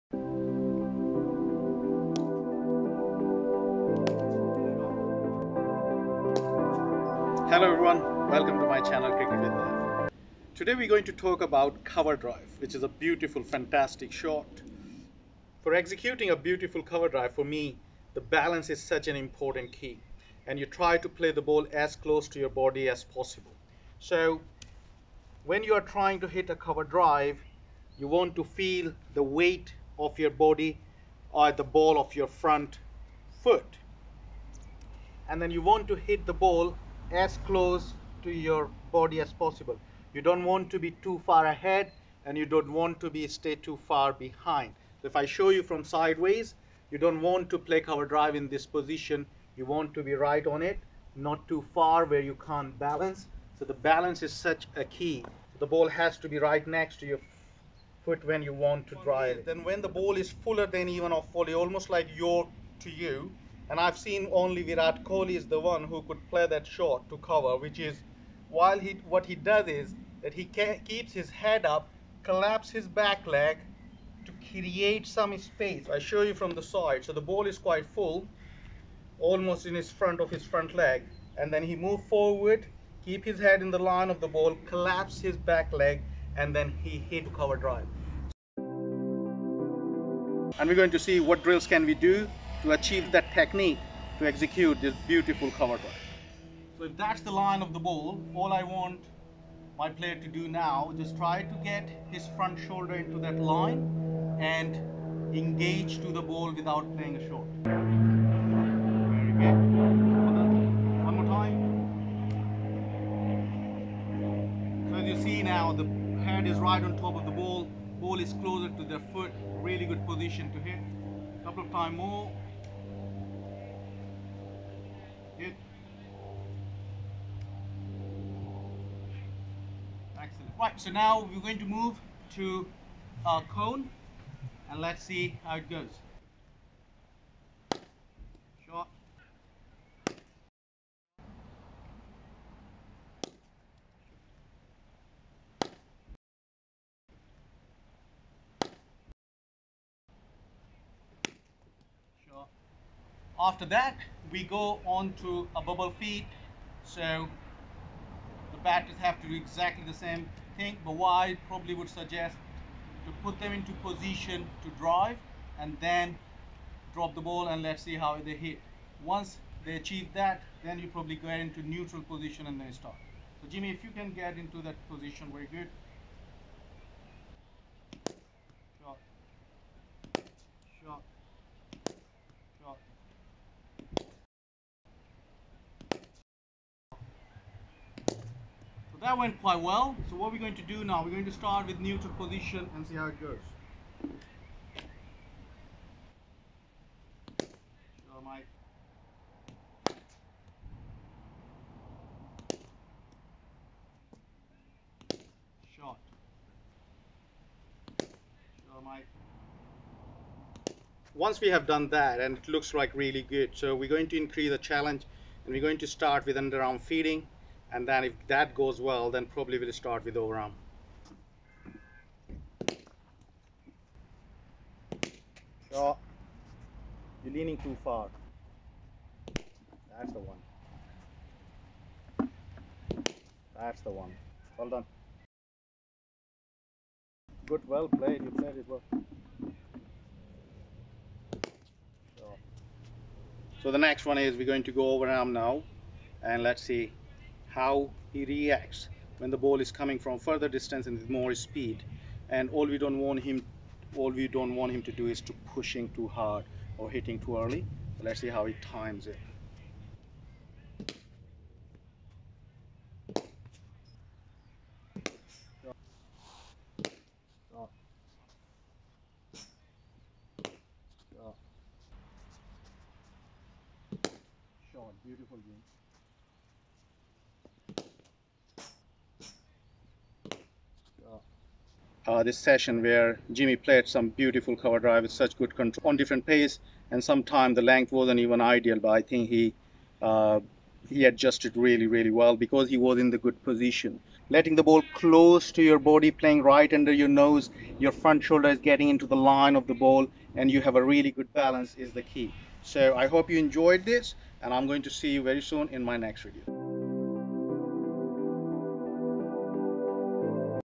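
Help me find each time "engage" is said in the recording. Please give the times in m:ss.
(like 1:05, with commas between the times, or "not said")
1:45.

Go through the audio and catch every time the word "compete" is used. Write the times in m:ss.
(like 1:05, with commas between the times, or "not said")
not said.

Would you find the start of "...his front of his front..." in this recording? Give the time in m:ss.
1:19.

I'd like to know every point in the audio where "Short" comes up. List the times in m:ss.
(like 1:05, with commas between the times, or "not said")
2:18, 2:32.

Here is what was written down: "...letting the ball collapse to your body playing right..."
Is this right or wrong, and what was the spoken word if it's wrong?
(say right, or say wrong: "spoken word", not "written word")
wrong: "close", not "collapse".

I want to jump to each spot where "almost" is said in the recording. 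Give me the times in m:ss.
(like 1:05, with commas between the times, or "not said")
1:01, 1:19.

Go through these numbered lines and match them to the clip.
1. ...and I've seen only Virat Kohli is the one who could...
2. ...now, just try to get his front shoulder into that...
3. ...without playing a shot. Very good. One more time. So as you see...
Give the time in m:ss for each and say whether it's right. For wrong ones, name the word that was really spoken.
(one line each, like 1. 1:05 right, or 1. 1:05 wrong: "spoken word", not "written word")
1. 1:03 right
2. 1:40 right
3. 1:46 right.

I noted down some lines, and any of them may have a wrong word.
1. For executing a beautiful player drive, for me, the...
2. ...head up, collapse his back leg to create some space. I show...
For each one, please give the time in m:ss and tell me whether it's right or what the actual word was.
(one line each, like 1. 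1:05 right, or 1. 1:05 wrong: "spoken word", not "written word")
1. 0:15 wrong: "cover", not "player"
2. 1:11 right.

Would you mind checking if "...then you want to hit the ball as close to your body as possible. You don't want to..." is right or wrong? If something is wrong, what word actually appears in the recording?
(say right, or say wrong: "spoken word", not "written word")
right.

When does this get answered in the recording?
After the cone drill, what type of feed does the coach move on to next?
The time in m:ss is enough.
2:35.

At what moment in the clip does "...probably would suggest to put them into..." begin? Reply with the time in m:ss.
2:41.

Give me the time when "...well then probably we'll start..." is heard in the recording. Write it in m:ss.
3:38.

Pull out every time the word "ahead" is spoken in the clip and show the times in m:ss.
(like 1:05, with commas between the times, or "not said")
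0:41.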